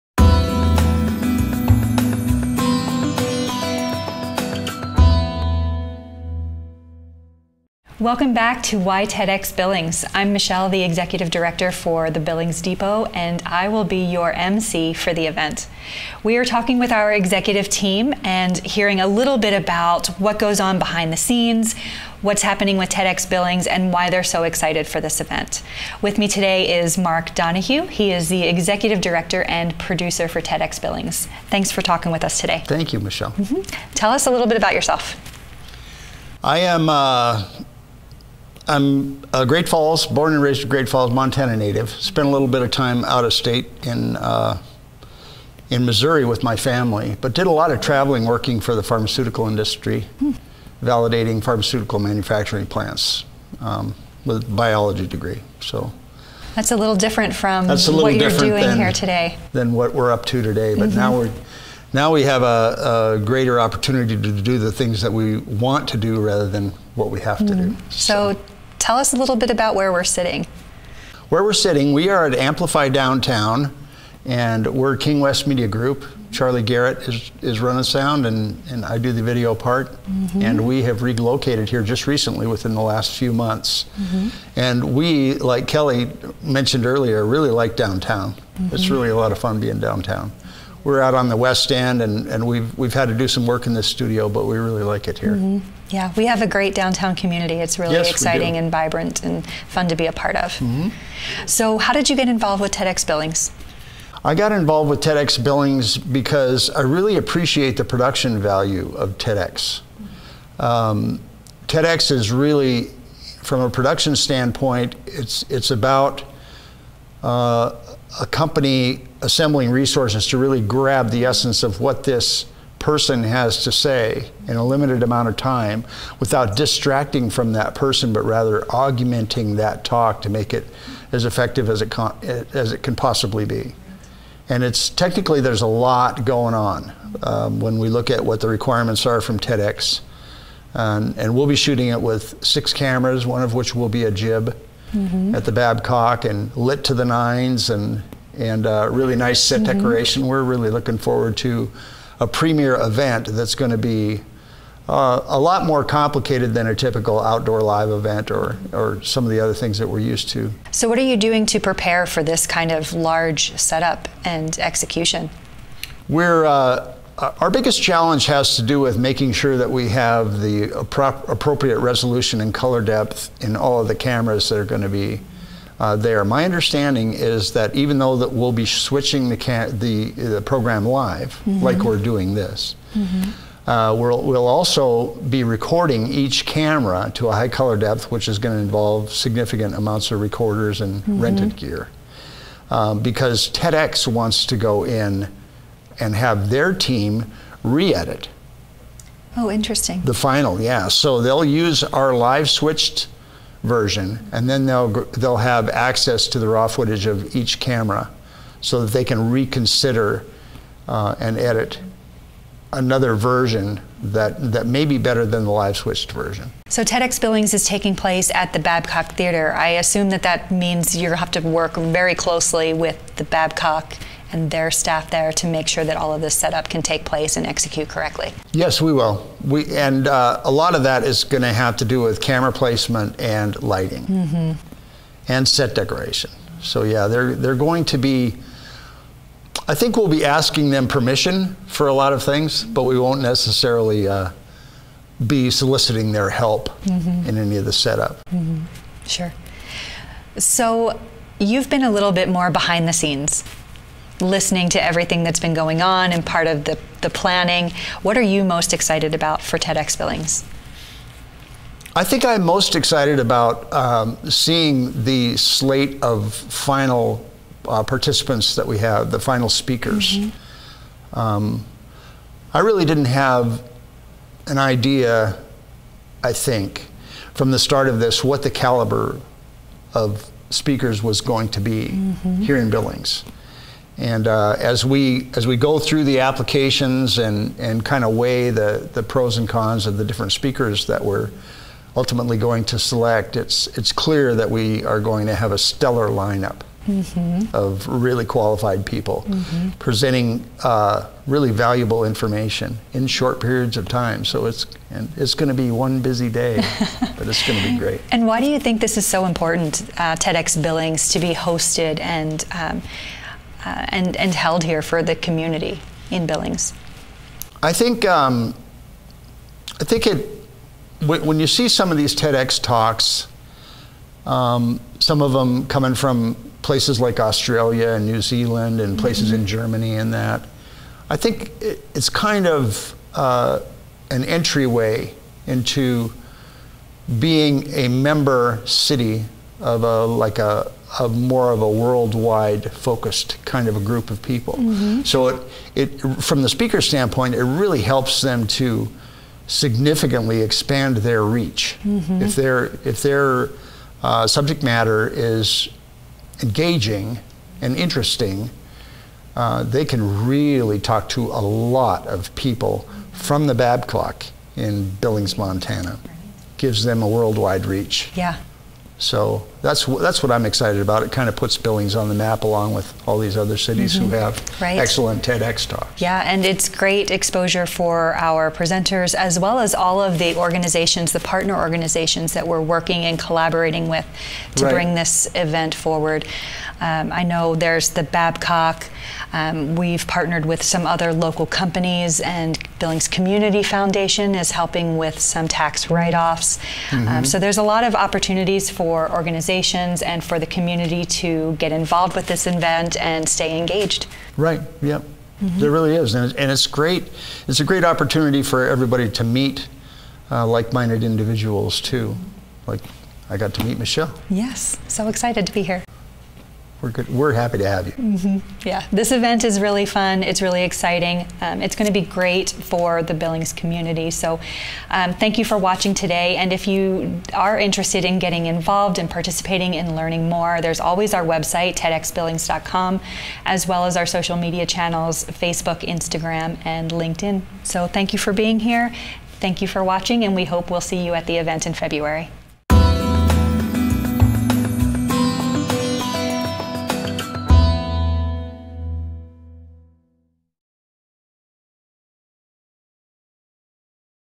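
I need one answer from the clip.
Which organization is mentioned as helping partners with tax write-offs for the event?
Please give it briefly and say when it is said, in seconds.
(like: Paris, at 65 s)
Billings Community Foundation, at 392 s.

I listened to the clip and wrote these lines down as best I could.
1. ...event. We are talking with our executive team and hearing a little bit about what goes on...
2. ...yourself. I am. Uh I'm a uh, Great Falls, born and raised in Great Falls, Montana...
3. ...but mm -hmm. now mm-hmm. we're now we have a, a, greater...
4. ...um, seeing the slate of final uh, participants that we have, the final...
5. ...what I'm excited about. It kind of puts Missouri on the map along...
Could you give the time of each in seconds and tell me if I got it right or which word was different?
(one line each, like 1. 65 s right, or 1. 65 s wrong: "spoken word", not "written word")
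1. 15 s right
2. 34 s right
3. 60 s right
4. 263 s right
5. 370 s wrong: "Billings", not "Missouri".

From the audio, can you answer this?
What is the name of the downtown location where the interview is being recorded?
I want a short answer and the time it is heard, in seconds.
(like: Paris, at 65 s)
Amplify Downtown, at 72 s.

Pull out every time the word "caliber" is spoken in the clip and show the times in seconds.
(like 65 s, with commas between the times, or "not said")
278 s.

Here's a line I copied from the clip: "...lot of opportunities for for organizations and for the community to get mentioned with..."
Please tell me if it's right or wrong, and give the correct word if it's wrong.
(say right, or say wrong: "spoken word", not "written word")
wrong: "involved", not "mentioned".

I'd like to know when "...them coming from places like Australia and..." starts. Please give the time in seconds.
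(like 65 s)
325 s.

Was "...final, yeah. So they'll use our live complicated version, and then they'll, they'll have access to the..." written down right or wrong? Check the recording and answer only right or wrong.
wrong.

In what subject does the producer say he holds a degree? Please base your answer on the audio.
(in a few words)
biology degree.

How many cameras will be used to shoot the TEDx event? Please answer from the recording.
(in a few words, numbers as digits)
6.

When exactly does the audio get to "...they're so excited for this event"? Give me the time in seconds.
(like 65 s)
24 s.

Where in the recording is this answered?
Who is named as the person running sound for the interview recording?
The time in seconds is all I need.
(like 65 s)
76 s.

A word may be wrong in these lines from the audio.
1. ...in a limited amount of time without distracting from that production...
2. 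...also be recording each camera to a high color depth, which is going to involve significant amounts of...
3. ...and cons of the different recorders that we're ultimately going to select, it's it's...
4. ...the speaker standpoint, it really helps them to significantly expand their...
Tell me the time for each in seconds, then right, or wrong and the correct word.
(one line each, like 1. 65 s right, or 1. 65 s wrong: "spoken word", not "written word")
1. 124 s wrong: "person", not "production"
2. 184 s right
3. 289 s wrong: "speakers", not "recorders"
4. 346 s right.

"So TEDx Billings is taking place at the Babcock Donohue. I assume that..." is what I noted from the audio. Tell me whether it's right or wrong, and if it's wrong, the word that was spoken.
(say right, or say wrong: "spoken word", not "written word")
wrong: "Theater", not "Donohue".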